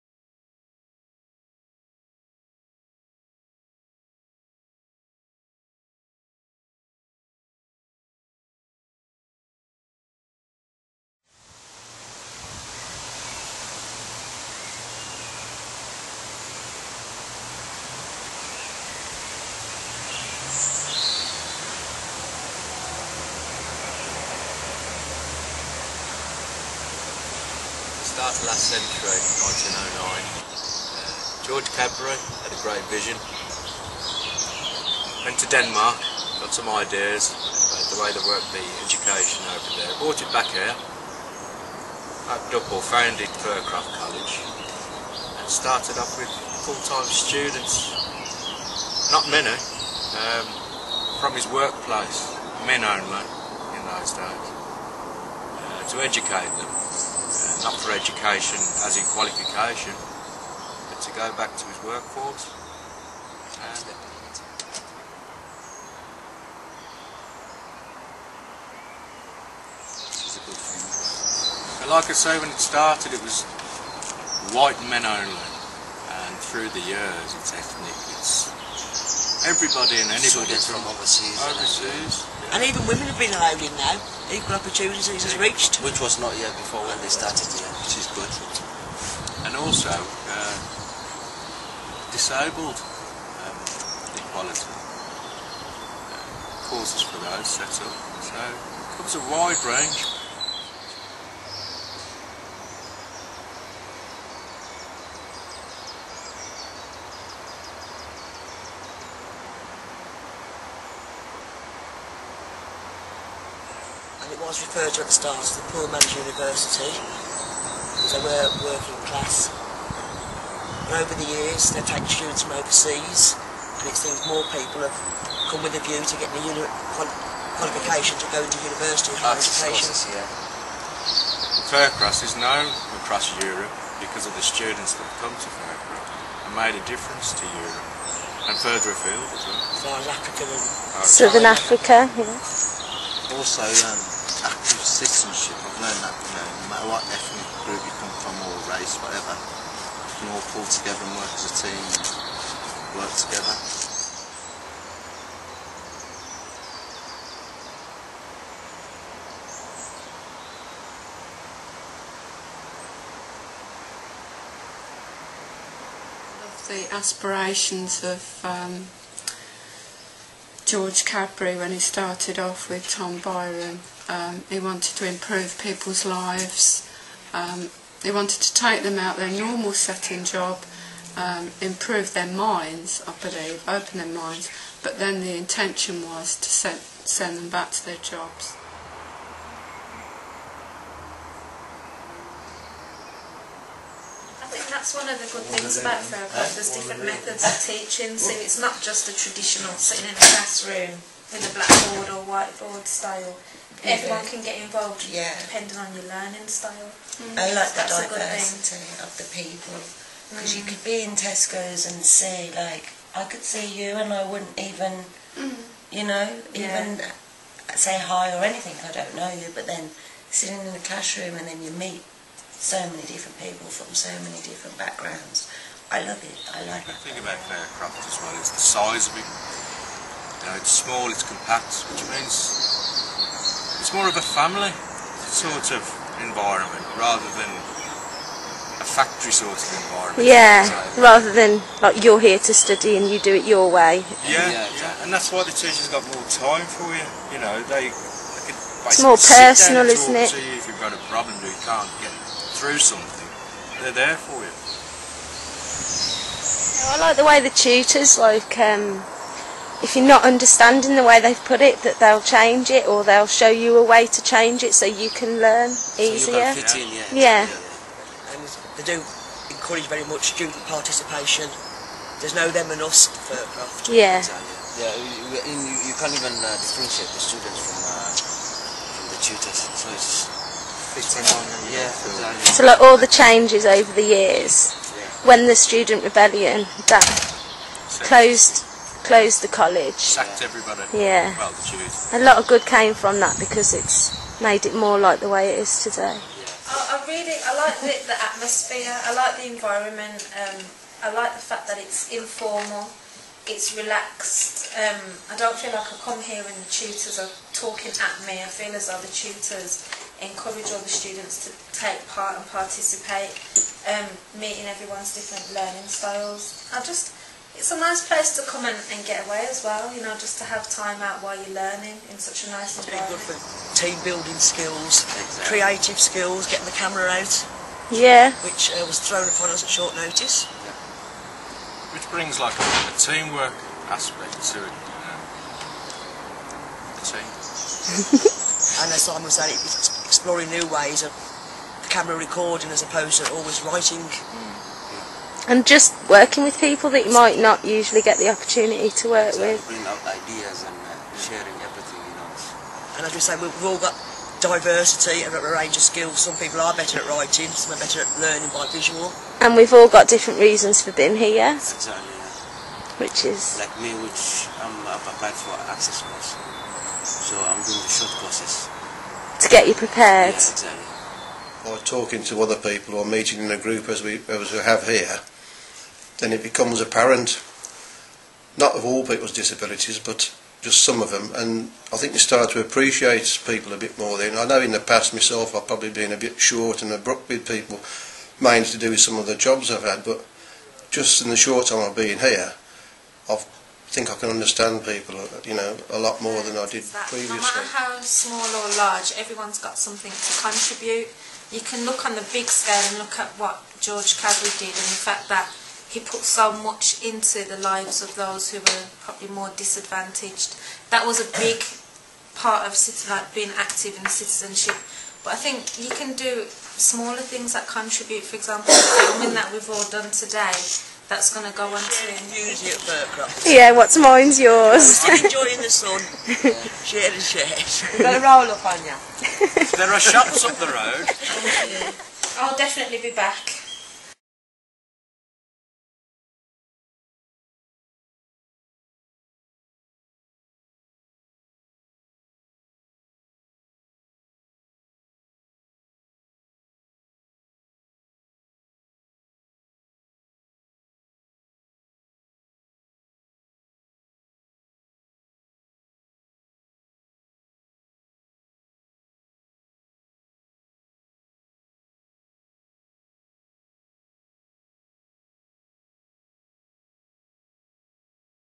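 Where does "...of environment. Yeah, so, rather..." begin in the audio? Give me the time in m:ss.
3:59.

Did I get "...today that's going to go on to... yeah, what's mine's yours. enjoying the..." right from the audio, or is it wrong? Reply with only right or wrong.
right.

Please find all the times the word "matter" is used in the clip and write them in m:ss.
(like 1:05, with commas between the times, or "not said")
2:26, 6:37.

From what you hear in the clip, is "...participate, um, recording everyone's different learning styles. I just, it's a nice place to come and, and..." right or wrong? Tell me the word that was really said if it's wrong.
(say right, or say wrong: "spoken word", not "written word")
wrong: "meeting", not "recording".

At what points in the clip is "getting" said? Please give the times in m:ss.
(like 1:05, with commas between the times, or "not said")
2:06, 5:26.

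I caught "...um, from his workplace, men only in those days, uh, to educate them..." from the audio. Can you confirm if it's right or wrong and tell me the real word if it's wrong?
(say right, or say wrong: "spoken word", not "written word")
right.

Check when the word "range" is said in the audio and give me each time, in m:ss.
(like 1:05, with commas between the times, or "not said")
1:39, 5:55.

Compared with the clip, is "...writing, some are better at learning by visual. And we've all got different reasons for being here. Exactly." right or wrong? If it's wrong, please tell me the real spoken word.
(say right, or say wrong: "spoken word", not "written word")
right.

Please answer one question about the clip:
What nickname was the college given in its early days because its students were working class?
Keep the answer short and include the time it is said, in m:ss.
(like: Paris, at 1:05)
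Poor Man's University, at 1:55.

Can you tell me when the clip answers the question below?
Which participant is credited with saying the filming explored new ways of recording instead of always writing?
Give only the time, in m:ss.
5:39.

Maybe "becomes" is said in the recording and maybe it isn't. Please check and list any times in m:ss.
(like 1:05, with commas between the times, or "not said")
6:16.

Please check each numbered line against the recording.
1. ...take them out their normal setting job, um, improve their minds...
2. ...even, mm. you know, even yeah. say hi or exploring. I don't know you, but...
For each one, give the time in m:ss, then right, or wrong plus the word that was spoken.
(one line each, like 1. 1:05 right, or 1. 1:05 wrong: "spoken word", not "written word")
1. 2:58 right
2. 3:34 wrong: "anything", not "exploring".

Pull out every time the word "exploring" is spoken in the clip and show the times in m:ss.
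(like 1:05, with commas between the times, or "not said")
5:40.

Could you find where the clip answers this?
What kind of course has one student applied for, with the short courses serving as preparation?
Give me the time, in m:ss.
6:05.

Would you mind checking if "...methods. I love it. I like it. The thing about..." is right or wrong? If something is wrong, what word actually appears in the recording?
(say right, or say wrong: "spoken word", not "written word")
wrong: "backgrounds", not "methods".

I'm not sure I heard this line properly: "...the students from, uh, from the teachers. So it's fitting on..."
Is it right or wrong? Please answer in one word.
wrong.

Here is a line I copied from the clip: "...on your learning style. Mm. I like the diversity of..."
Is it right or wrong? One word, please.
right.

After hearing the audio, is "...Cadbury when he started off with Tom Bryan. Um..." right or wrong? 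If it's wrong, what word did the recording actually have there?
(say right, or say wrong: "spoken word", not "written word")
right.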